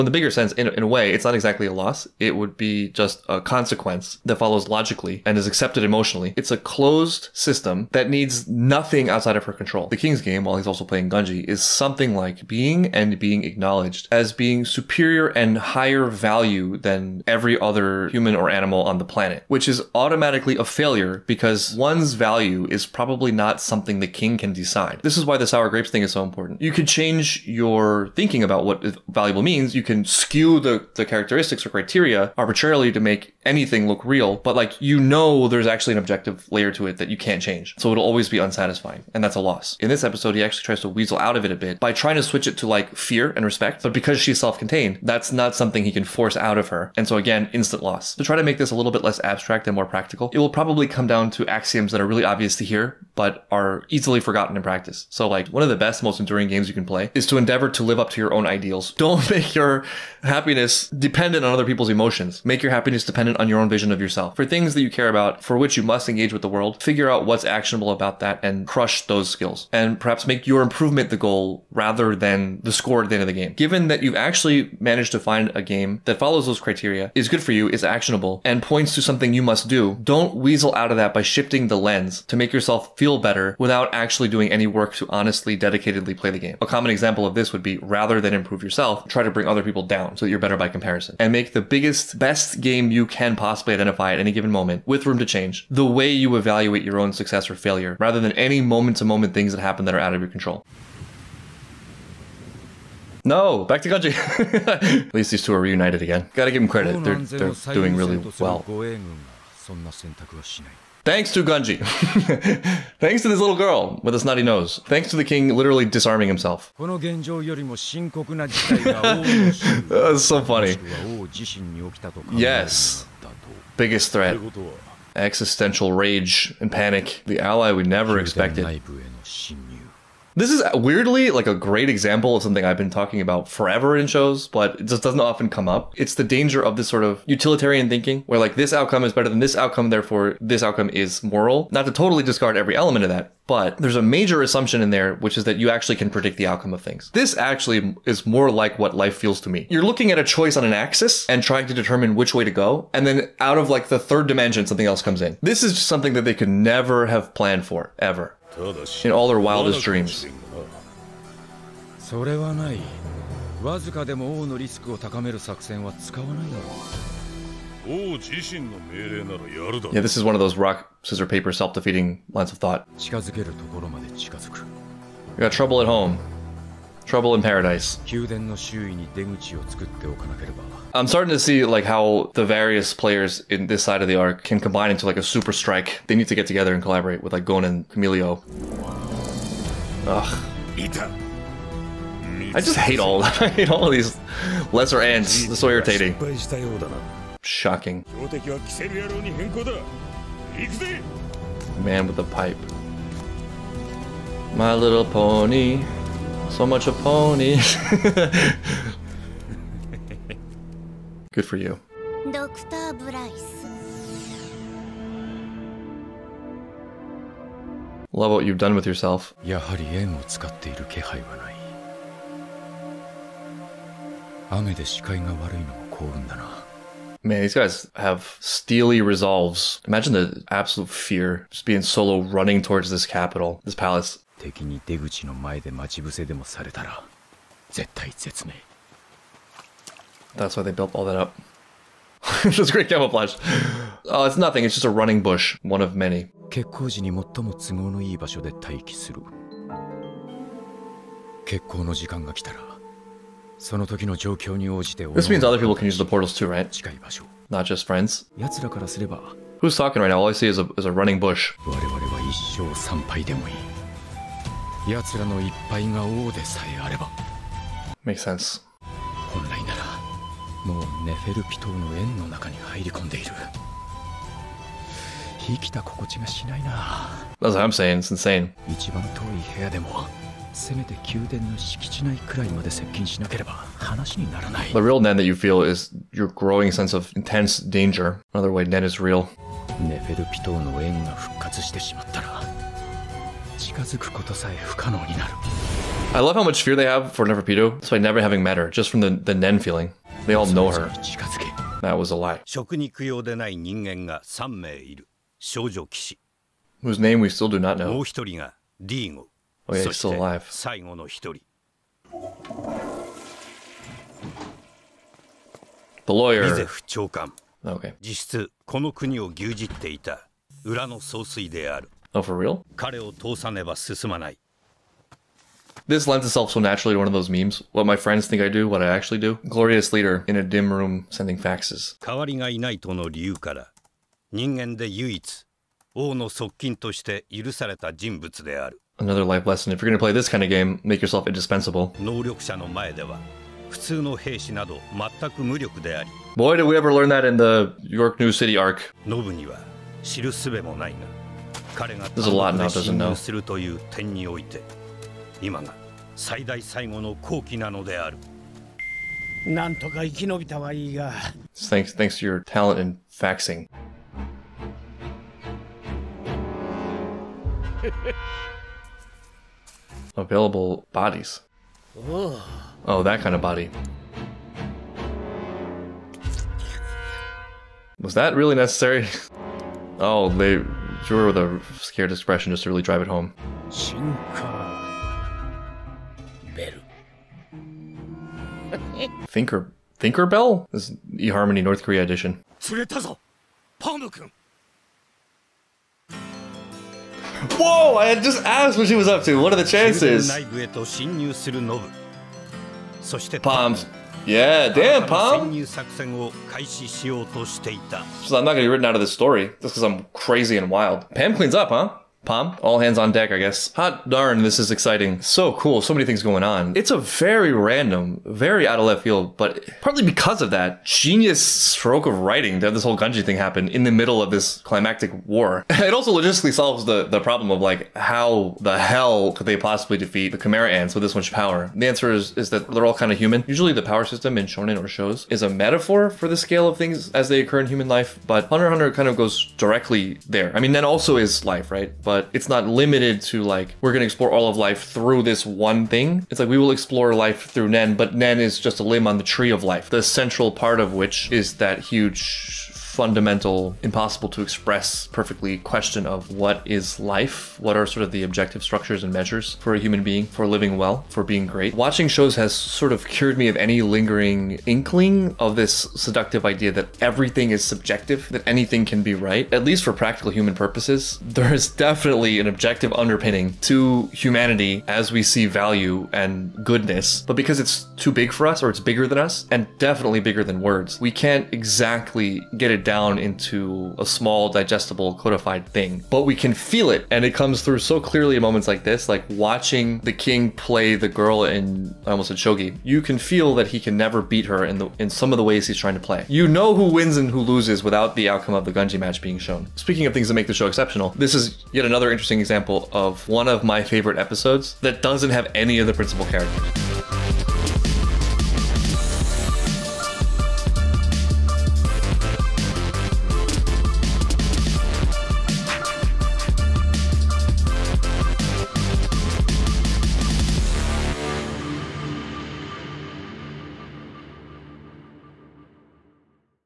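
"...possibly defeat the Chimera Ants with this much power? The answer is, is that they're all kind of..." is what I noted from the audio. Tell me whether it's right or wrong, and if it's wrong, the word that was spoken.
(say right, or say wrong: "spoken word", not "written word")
right.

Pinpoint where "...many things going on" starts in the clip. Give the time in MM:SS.
06:55.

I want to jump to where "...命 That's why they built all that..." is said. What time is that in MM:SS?
03:58.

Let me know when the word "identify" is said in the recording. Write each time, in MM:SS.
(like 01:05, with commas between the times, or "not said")
01:33.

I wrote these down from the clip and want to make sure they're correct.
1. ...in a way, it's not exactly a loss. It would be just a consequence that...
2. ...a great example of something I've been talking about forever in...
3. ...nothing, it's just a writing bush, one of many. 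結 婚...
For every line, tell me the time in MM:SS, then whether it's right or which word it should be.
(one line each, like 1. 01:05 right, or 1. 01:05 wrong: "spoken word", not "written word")
1. 00:00 right
2. 02:11 right
3. 04:04 wrong: "running", not "writing".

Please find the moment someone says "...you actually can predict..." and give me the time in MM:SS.
02:25.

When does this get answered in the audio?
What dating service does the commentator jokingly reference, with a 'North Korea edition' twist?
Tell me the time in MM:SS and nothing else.
06:31.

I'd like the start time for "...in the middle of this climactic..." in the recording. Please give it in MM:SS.
07:03.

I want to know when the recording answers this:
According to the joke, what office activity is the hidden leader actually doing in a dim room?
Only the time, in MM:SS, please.
05:31.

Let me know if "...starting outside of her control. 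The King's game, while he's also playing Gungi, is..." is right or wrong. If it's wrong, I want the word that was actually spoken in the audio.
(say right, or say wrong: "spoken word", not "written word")
wrong: "nothing", not "starting".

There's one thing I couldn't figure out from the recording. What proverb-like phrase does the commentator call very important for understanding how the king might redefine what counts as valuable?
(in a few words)
sour grapes.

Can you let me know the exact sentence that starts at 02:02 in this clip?
Yes biggest threat existential rage and panic, the ally we never expected.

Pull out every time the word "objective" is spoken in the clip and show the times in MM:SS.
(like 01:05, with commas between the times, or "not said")
00:35, 07:38, 07:52.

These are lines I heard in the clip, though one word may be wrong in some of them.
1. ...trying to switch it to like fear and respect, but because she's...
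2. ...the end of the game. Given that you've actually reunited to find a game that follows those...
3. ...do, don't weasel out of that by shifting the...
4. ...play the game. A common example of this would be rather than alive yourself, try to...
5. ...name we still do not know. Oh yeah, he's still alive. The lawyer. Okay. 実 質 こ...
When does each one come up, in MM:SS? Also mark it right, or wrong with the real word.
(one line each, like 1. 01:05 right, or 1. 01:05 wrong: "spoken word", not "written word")
1. 00:41 right
2. 01:13 wrong: "managed", not "reunited"
3. 01:19 right
4. 01:26 wrong: "improve", not "alive"
5. 05:06 right.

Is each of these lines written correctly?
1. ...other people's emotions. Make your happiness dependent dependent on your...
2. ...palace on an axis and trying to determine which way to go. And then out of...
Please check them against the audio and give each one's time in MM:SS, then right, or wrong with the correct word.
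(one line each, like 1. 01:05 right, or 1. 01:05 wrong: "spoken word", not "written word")
1. 01:01 right
2. 02:30 wrong: "choice", not "palace".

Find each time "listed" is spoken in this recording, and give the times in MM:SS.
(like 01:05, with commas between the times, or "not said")
not said.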